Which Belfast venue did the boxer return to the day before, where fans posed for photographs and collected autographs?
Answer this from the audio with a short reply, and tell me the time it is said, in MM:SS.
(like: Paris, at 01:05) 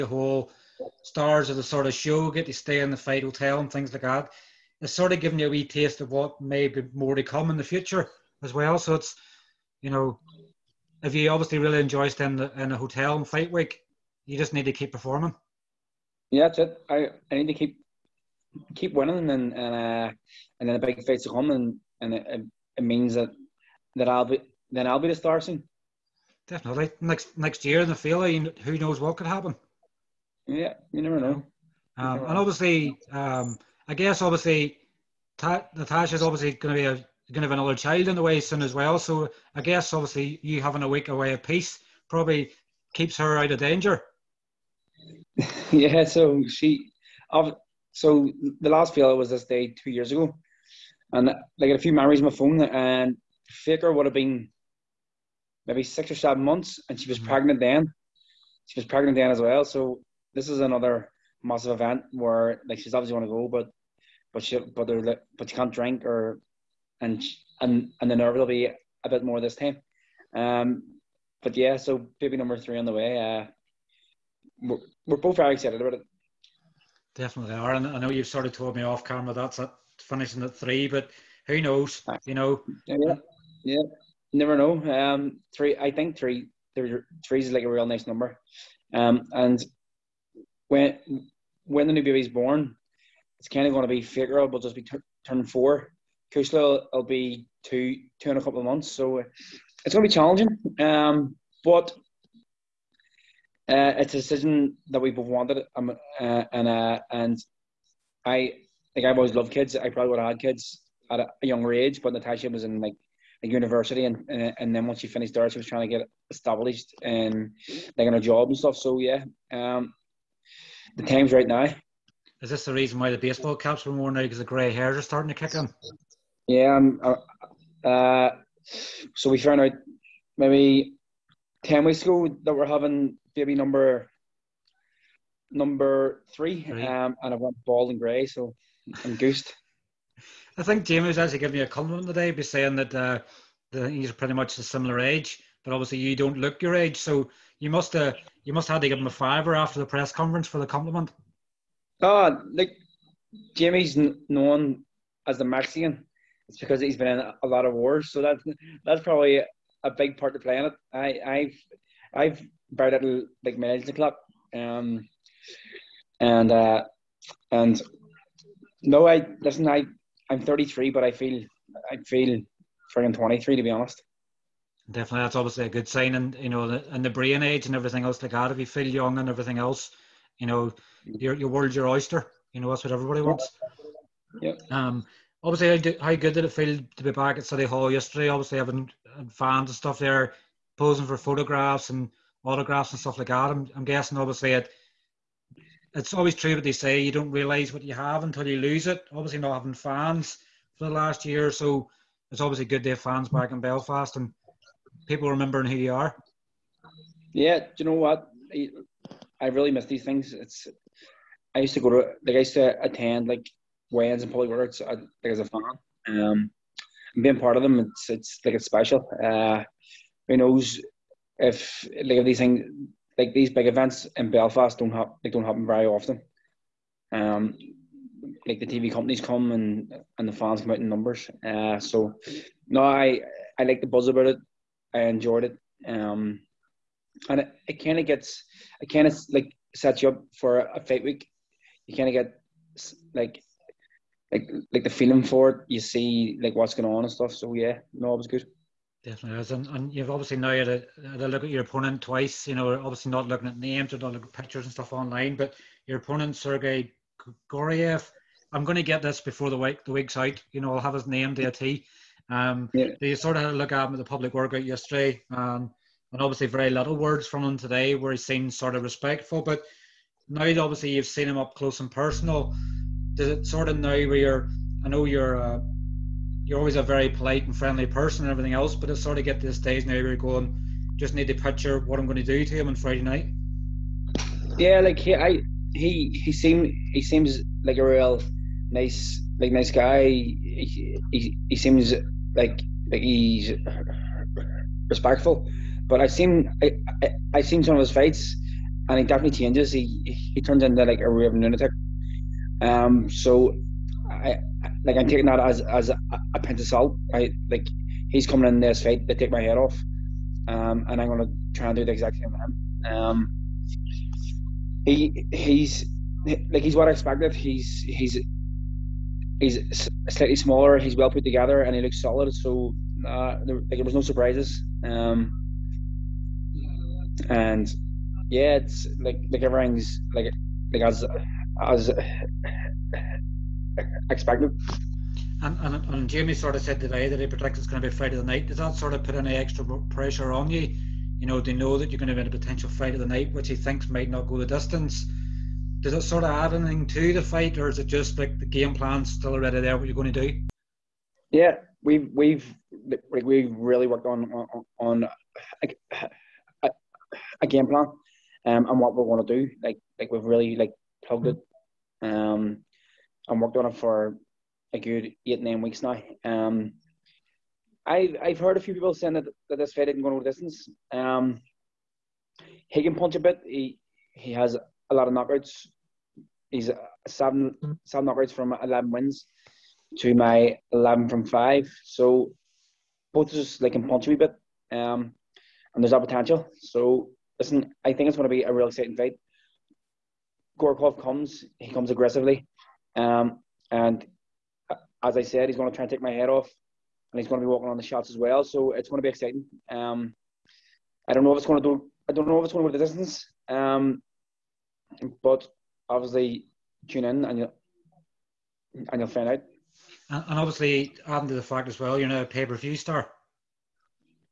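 City Hall, at 03:07.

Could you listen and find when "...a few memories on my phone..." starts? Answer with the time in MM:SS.
00:51.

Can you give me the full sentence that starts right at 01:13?
Uh, we're, we're both very excited about it.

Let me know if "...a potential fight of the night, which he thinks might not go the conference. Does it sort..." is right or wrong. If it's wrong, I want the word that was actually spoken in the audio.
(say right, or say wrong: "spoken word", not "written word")
wrong: "distance", not "conference".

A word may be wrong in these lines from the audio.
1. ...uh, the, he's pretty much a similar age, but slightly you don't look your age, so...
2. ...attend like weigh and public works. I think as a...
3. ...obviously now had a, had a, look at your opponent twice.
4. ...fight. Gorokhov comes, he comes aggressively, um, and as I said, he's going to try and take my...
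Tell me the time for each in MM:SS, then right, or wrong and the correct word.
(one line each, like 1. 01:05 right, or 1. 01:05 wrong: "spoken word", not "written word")
1. 02:22 wrong: "obviously", not "slightly"
2. 03:32 right
3. 04:10 right
4. 06:28 right.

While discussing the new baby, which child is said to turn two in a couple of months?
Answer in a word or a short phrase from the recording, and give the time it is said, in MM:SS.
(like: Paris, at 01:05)
Kushla, at 01:36.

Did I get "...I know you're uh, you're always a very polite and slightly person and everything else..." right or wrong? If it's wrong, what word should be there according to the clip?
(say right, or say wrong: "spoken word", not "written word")
wrong: "friendly", not "slightly".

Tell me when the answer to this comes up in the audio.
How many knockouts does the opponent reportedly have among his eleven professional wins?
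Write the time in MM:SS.
06:17.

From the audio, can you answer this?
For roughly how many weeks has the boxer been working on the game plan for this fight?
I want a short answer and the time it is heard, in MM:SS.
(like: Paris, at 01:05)
8 or 9 weeks, at 06:05.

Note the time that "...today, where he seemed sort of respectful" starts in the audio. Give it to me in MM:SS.
04:27.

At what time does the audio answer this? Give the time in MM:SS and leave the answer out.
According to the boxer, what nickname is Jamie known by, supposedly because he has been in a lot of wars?
02:35.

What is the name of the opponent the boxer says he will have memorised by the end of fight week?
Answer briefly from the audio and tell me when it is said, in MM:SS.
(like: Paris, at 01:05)
Sergey Goryev, at 04:16.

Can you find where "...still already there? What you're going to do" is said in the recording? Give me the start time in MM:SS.
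05:49.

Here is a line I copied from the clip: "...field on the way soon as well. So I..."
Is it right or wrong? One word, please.
wrong.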